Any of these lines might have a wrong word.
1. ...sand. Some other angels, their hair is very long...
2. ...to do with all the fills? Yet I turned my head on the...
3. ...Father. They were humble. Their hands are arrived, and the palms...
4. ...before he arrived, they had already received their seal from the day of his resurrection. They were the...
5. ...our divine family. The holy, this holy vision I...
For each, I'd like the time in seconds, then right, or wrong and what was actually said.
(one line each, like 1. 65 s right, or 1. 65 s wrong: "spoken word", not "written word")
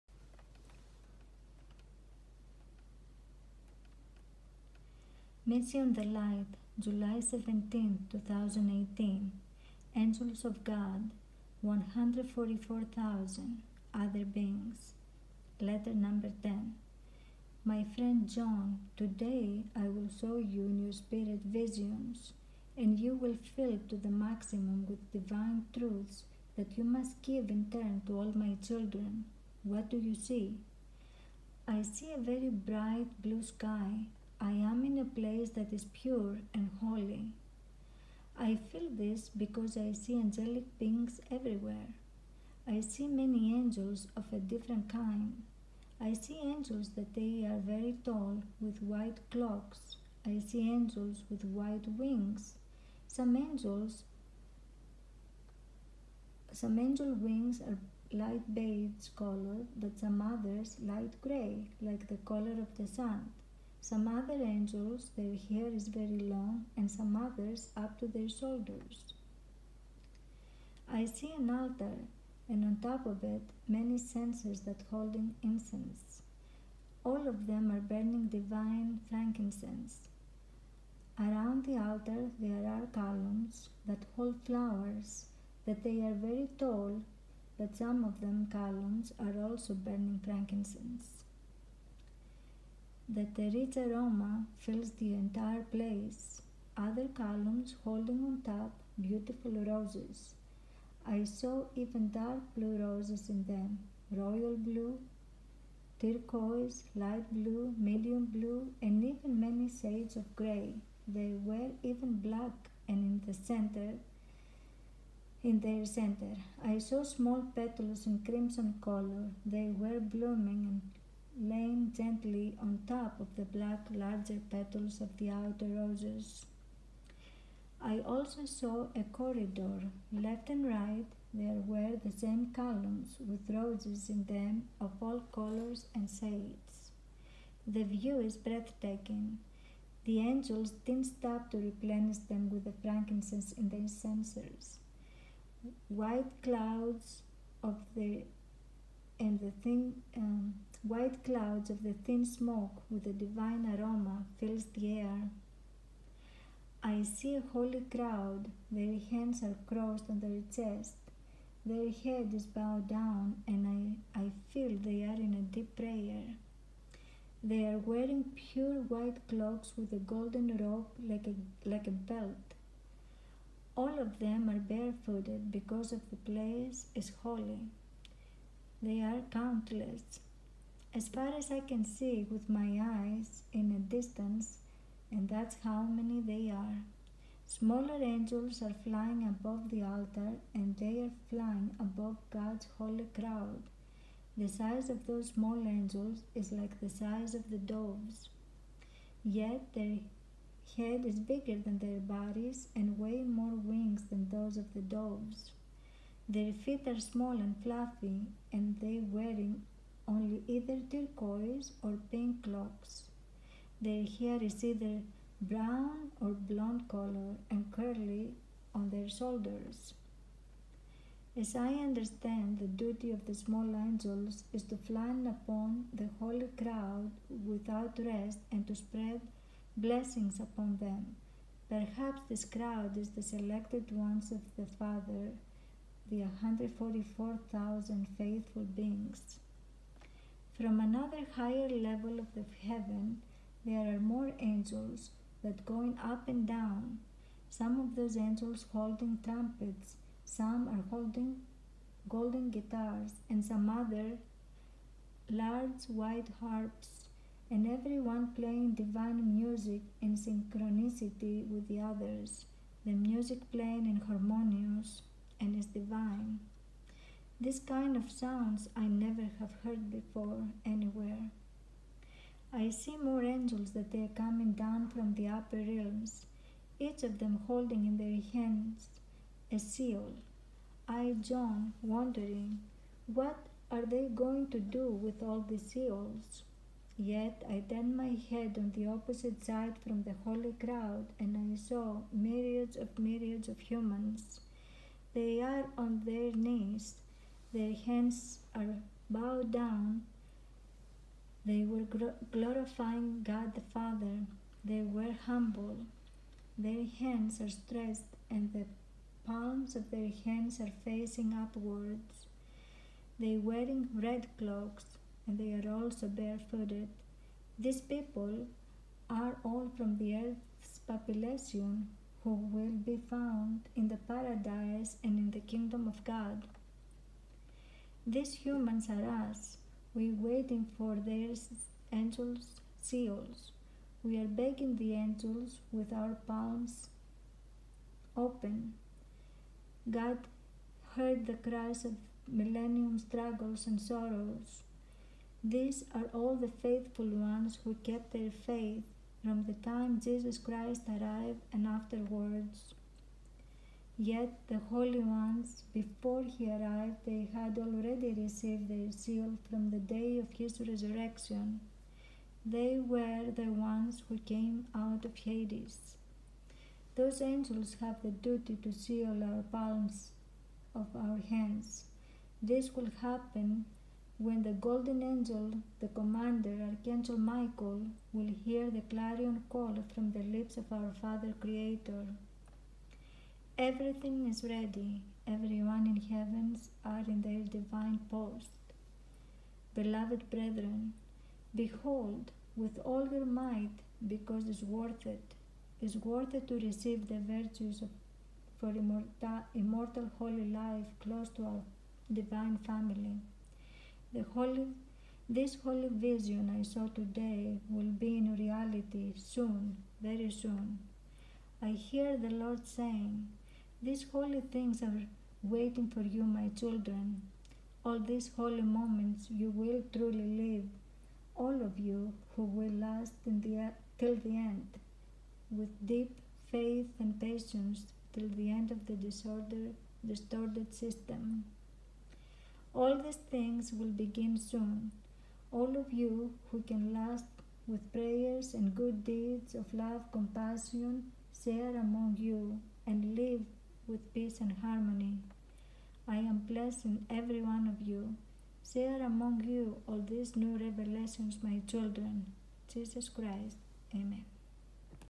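1. 62 s right
2. 284 s wrong: "seals", not "fills"
3. 303 s wrong: "stretched", not "arrived"
4. 355 s right
5. 401 s right.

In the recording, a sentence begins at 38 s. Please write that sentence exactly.
I feel this because I see angelic beings everywhere.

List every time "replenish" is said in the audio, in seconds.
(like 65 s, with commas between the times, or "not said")
141 s.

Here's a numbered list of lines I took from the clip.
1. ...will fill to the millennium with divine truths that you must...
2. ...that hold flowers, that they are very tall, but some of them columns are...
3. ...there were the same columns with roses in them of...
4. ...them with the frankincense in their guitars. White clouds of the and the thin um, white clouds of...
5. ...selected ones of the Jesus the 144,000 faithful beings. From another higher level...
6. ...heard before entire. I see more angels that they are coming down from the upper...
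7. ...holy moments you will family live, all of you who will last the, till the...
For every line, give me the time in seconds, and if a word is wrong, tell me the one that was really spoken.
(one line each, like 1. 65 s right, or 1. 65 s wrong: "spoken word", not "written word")
1. 23 s wrong: "maximum", not "millennium"
2. 83 s right
3. 131 s right
4. 142 s wrong: "censers", not "guitars"
5. 233 s wrong: "Father", not "Jesus"
6. 269 s wrong: "anywhere", not "entire"
7. 418 s wrong: "truly", not "family".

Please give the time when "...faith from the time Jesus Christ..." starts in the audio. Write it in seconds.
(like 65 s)
348 s.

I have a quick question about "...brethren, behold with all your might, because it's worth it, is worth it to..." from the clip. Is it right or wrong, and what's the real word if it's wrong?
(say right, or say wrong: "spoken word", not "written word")
right.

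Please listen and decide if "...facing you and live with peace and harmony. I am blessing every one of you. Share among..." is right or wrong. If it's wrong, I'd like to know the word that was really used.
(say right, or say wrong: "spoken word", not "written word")
wrong: "among", not "facing".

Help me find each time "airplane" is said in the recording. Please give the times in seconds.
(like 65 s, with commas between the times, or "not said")
not said.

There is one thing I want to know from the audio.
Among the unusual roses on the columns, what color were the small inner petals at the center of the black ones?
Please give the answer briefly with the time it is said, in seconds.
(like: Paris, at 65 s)
Crimson, at 118 s.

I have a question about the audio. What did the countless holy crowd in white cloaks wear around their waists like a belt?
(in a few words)
A golden rope.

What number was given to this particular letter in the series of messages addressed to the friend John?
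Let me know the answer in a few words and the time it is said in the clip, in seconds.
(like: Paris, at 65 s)
10, at 15 s.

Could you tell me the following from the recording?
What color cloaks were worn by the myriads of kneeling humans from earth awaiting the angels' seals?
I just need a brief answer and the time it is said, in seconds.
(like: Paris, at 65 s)
Red, at 313 s.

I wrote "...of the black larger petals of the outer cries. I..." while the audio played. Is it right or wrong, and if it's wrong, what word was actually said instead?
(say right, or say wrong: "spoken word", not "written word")
wrong: "roses", not "cries".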